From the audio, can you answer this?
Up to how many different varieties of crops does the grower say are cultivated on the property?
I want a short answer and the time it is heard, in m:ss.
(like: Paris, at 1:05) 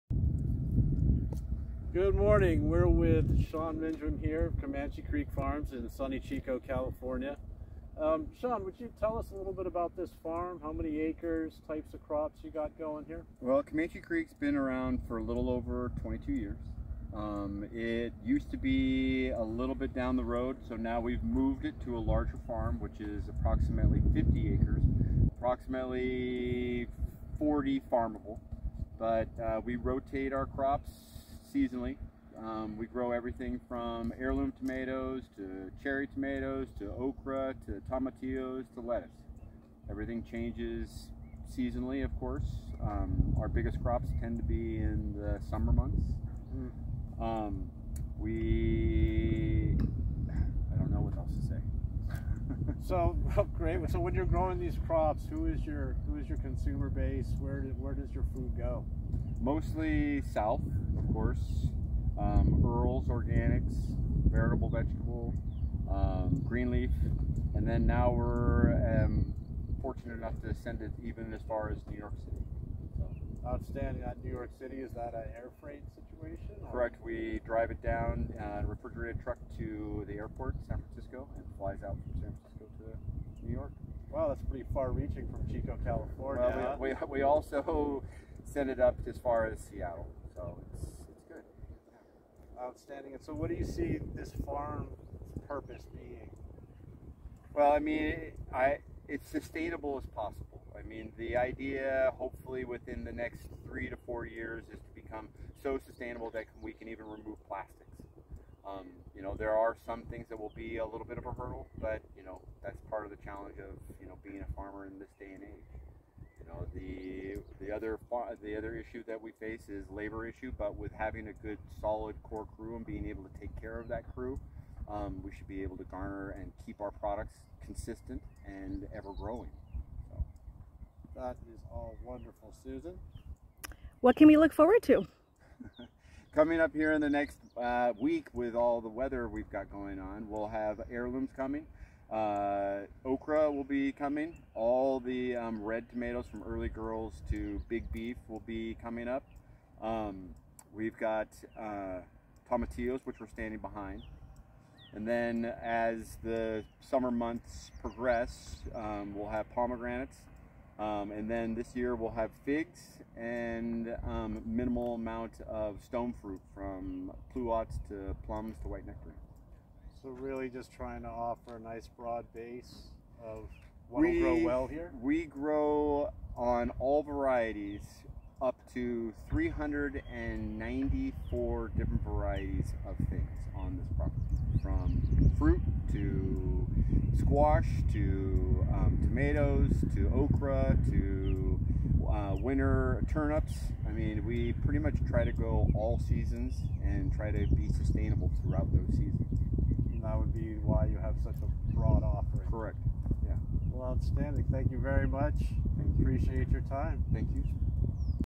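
394, at 2:59.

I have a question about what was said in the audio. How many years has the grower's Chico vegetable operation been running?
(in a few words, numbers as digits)
22.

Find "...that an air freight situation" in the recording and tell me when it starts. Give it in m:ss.
1:14.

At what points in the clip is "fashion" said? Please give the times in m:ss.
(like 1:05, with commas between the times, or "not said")
not said.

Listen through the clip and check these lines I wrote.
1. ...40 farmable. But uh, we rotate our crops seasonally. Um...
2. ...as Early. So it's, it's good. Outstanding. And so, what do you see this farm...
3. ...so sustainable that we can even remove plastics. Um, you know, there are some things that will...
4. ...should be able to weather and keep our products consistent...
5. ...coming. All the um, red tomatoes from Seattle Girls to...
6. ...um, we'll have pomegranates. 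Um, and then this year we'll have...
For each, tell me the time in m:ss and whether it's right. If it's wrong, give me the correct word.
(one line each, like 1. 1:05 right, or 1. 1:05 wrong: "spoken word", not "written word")
1. 0:27 right
2. 1:29 wrong: "Seattle", not "Early"
3. 1:45 right
4. 2:05 wrong: "garner", not "weather"
5. 2:23 wrong: "Early", not "Seattle"
6. 2:38 right.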